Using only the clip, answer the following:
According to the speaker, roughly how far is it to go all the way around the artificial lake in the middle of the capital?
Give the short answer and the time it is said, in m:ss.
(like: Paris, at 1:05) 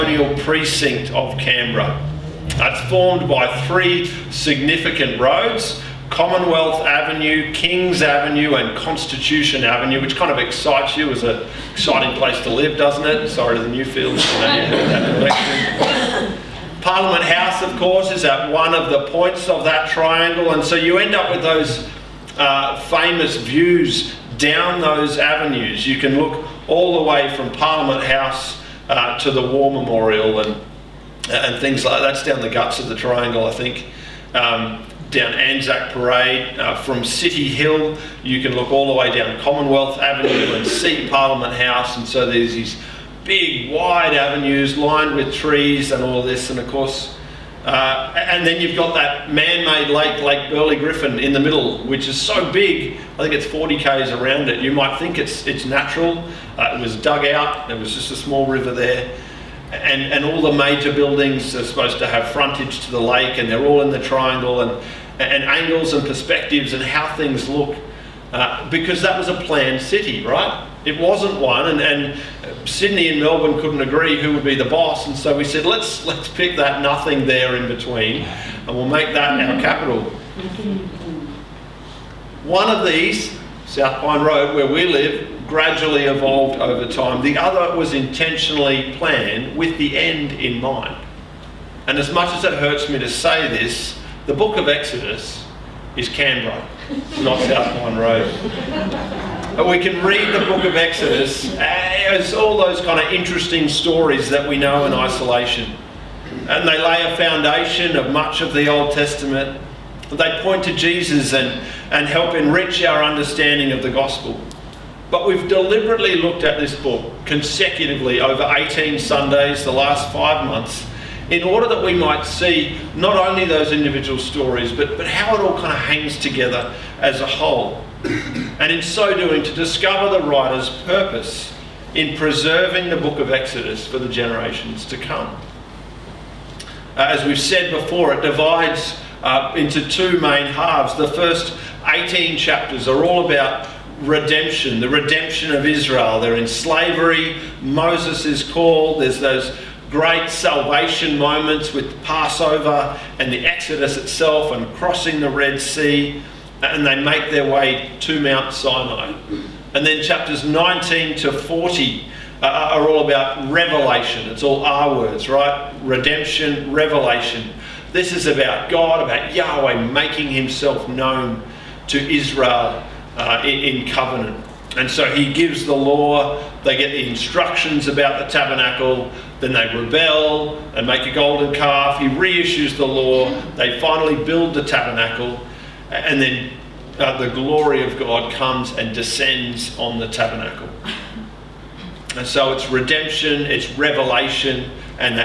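40 km, at 0:53.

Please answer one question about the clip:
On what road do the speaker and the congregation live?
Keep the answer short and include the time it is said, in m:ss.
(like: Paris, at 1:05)
South Pine Road, at 1:23.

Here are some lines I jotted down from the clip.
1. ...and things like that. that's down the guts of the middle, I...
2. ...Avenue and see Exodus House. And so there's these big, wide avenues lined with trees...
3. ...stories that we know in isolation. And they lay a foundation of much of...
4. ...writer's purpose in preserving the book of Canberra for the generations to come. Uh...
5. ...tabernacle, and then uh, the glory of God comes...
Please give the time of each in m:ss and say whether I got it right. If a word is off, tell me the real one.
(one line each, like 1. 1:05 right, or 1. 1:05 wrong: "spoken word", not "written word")
1. 0:31 wrong: "triangle", not "middle"
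2. 0:39 wrong: "Parliament", not "Exodus"
3. 1:43 right
4. 2:10 wrong: "Exodus", not "Canberra"
5. 3:04 right.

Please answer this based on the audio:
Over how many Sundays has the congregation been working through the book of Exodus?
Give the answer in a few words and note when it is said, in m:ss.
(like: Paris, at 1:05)
18, at 1:58.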